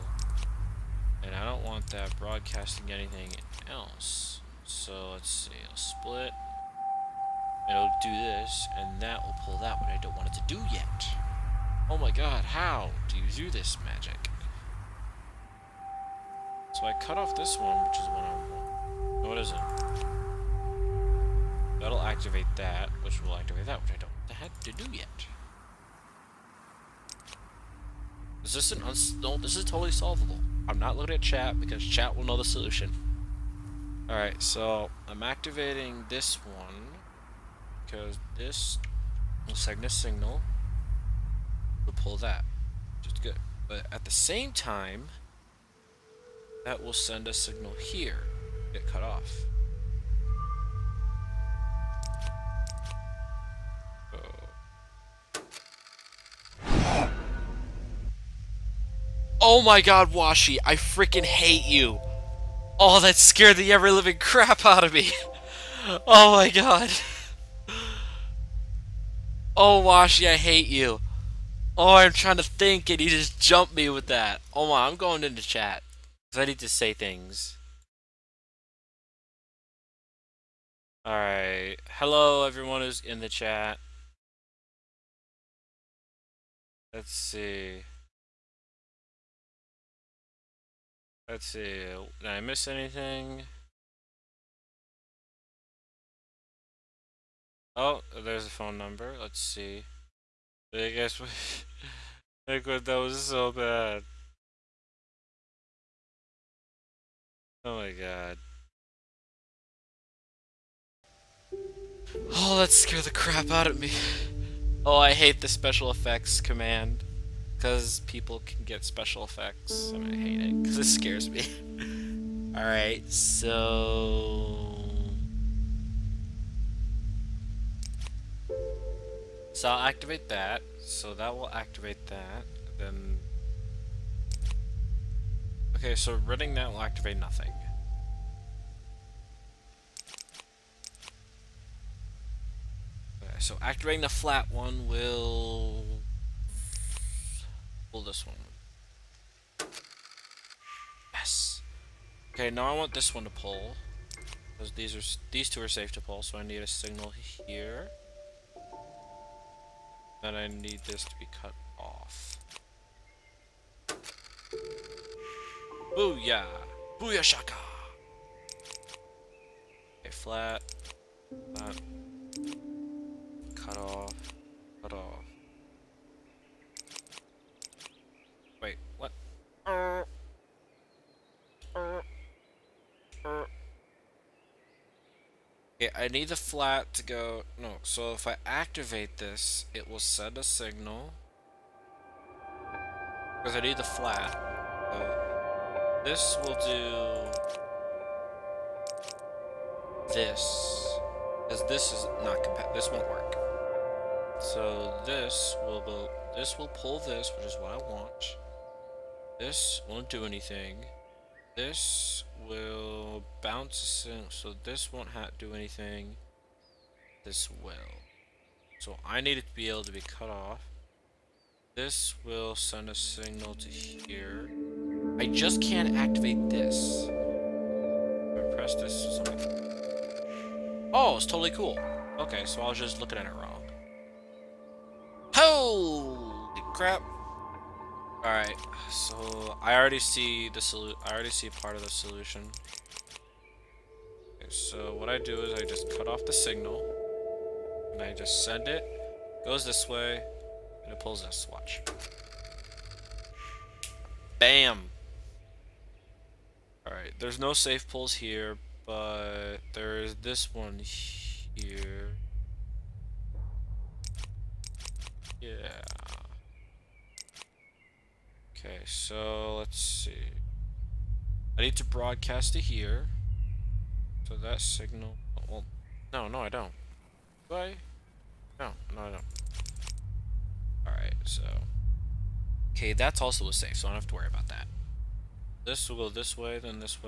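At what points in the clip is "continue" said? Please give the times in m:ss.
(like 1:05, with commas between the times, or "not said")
not said.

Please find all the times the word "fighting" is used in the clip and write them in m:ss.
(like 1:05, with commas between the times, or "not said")
not said.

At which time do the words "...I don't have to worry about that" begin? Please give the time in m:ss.
4:43.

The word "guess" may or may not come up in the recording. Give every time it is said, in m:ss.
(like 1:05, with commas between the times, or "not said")
1:40.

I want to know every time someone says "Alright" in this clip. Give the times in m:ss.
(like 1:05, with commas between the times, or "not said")
0:34, 1:21, 2:02, 3:58, 4:16, 4:40.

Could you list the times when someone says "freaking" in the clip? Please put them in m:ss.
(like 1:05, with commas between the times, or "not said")
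1:00.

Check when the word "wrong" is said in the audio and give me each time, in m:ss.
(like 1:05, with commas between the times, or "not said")
3:53.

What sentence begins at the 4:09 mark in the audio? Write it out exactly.
Goes this way and it pulls this watch.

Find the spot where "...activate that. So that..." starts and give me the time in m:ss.
2:09.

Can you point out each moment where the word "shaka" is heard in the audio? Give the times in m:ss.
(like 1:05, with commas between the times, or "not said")
2:47.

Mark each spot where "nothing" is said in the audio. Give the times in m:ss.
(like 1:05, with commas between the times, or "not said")
2:17.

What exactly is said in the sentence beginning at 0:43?
But at the same time, that will send a signal here, get cut off.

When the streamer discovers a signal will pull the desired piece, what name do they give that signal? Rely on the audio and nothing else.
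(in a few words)
Cygnus signal.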